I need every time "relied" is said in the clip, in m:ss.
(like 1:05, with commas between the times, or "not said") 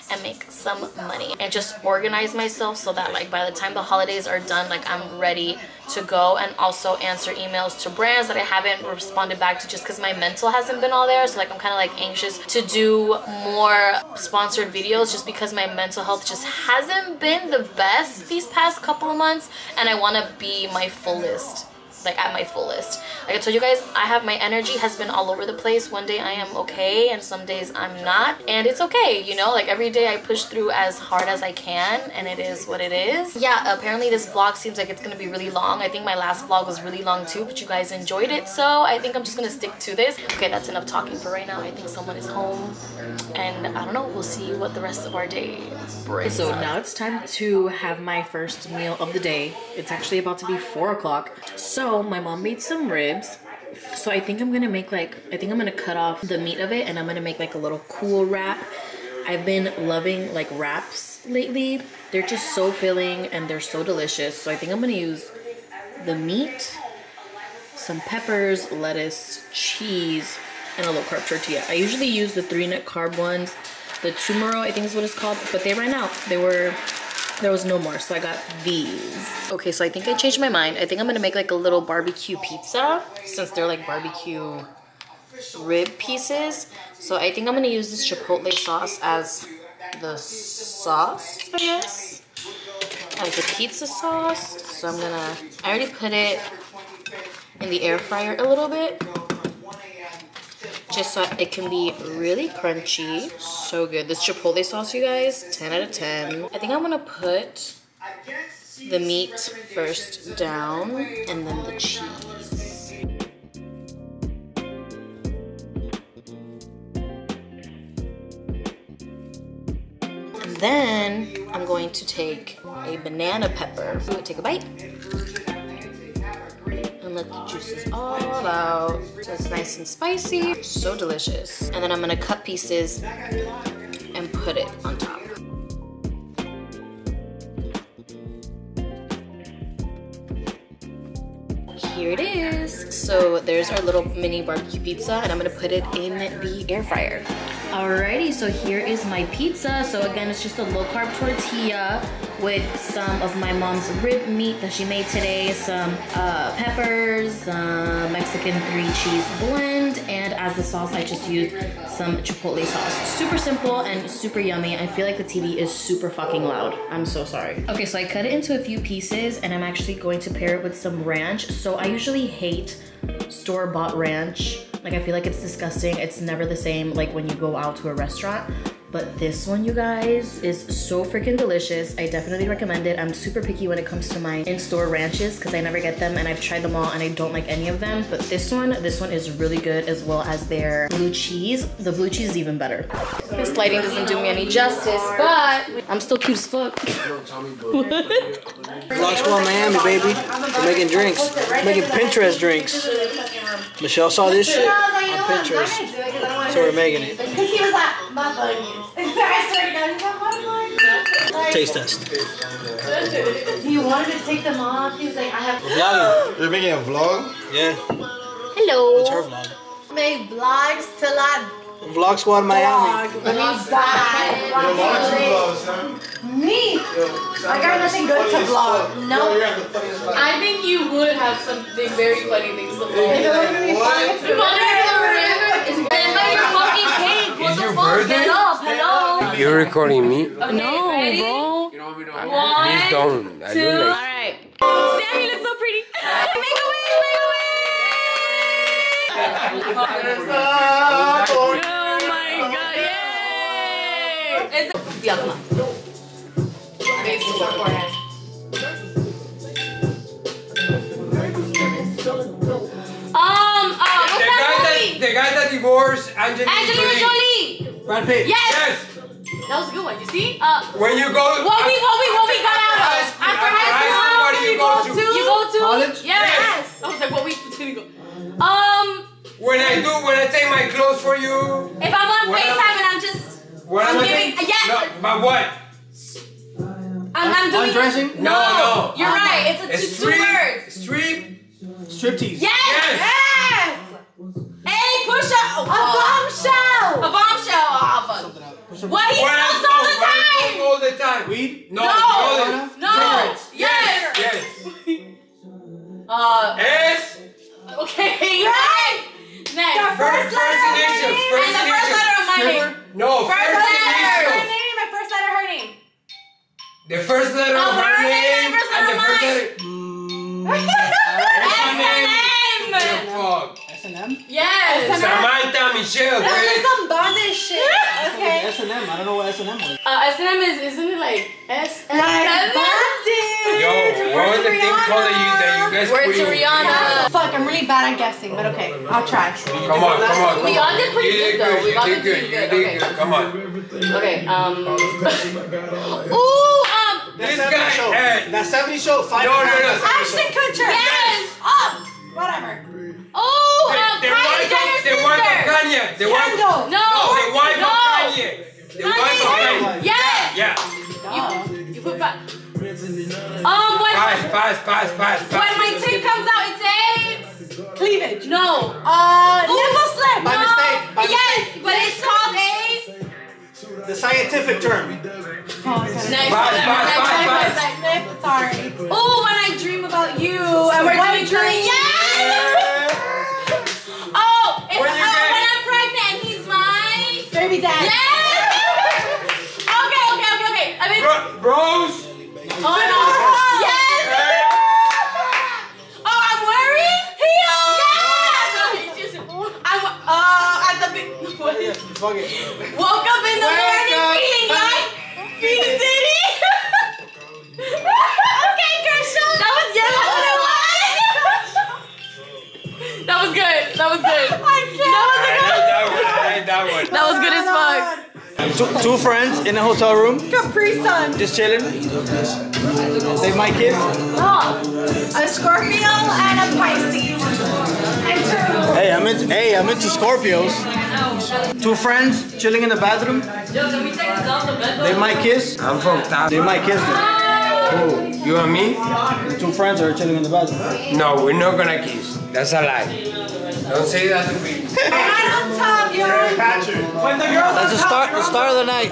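not said.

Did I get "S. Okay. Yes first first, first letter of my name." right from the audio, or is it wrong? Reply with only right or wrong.
right.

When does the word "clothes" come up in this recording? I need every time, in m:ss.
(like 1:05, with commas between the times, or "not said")
4:40.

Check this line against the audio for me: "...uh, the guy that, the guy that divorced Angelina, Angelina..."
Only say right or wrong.
right.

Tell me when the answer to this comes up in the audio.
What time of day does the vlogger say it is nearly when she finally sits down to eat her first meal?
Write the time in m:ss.
0:50.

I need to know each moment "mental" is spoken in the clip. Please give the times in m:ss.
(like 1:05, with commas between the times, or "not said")
0:10, 0:15.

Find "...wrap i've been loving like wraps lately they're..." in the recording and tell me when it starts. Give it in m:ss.
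0:58.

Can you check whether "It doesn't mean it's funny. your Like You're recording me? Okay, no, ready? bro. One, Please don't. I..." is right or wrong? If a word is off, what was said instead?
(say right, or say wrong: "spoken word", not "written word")
wrong: "What", not "Like".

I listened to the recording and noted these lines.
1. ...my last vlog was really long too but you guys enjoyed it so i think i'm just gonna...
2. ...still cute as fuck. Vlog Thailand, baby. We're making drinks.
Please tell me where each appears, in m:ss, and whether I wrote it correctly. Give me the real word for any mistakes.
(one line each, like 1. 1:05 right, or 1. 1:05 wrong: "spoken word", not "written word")
1. 0:36 right
2. 3:15 wrong: "Miami", not "Thailand".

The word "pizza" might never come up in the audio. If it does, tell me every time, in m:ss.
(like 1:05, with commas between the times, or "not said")
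1:22, 1:33, 2:24, 2:29.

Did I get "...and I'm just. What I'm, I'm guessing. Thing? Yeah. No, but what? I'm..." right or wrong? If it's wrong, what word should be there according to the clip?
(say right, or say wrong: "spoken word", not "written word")
wrong: "giving", not "guessing".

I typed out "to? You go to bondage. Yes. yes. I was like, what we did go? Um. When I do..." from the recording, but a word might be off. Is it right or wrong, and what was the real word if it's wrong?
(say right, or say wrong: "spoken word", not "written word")
wrong: "college", not "bondage".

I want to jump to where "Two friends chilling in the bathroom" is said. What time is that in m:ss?
7:11.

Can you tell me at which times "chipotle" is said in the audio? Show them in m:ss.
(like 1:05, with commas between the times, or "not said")
1:28, 1:44, 2:42.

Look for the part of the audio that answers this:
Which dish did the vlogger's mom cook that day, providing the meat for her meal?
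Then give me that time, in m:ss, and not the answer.
0:52.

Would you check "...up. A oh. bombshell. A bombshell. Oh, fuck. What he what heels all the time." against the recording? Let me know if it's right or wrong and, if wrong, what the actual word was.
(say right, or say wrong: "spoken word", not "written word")
wrong: "smells", not "heels".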